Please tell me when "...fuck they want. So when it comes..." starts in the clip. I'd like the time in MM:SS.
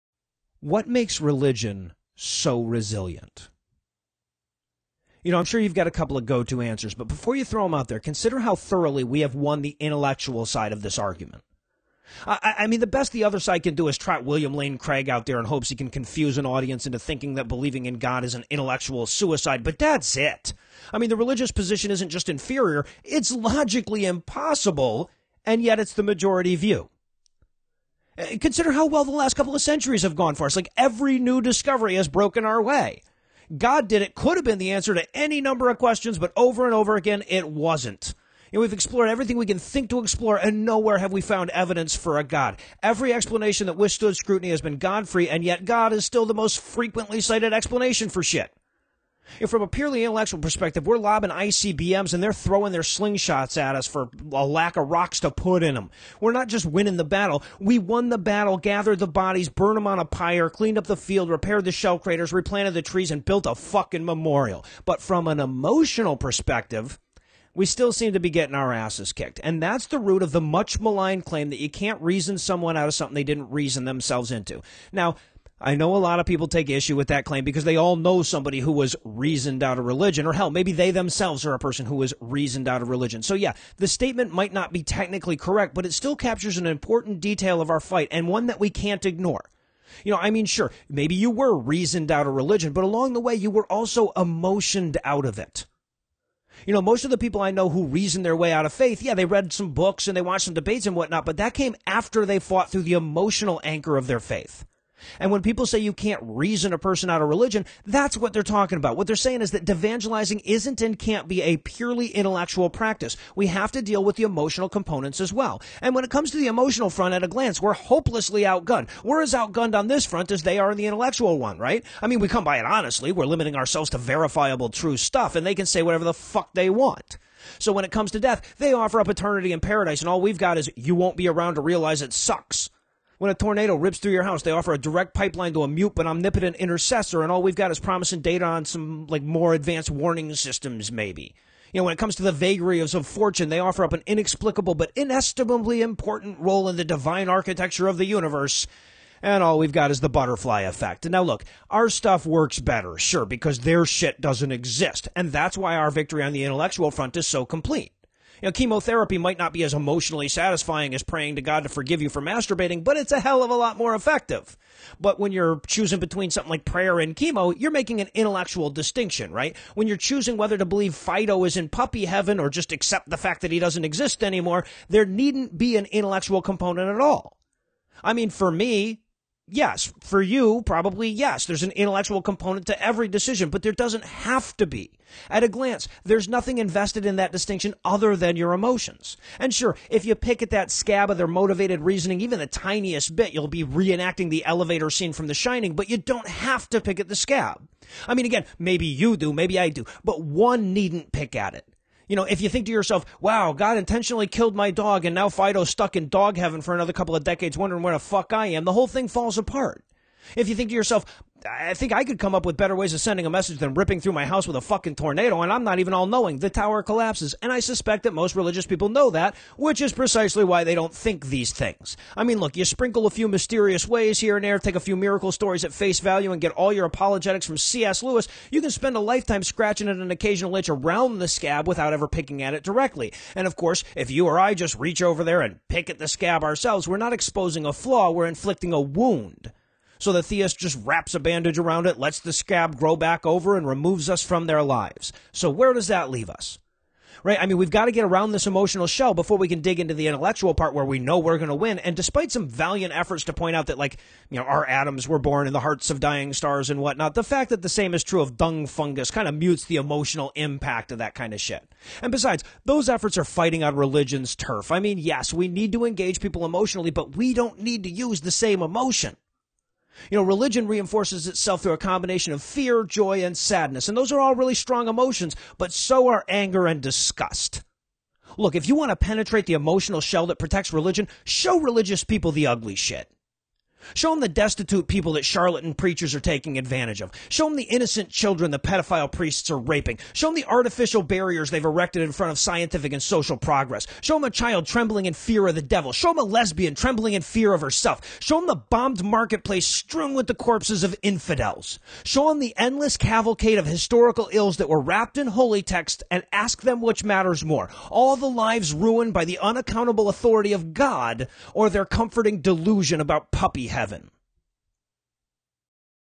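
02:06.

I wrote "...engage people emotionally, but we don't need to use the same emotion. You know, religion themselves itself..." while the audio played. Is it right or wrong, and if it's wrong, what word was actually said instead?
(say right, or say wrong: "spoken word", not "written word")
wrong: "reinforces", not "themselves".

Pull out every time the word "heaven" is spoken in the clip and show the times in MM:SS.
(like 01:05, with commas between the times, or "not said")
02:52, 03:26, 05:13.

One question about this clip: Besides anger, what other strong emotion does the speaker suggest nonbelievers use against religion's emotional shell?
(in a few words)
disgust.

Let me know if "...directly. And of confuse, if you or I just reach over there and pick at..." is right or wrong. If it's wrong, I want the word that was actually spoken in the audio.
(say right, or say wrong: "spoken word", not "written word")
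wrong: "course", not "confuse".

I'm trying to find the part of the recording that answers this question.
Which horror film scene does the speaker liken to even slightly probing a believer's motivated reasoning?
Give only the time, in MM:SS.
03:14.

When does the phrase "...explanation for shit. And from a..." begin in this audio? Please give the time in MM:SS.
00:47.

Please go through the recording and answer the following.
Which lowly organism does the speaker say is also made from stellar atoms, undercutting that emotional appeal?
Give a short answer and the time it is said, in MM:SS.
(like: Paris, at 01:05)
dung fungus, at 04:18.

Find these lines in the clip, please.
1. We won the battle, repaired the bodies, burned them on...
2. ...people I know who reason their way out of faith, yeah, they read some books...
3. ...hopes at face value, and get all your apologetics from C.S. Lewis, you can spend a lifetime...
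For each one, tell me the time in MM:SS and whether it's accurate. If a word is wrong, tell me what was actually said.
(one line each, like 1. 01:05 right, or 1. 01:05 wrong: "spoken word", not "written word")
1. 00:57 wrong: "gathered", not "repaired"
2. 01:37 right
3. 03:45 wrong: "stories", not "hopes".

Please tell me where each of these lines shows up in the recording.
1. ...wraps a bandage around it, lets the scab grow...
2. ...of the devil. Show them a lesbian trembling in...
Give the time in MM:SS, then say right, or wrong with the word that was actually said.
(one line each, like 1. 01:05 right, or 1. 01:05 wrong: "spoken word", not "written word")
1. 04:00 right
2. 04:55 right.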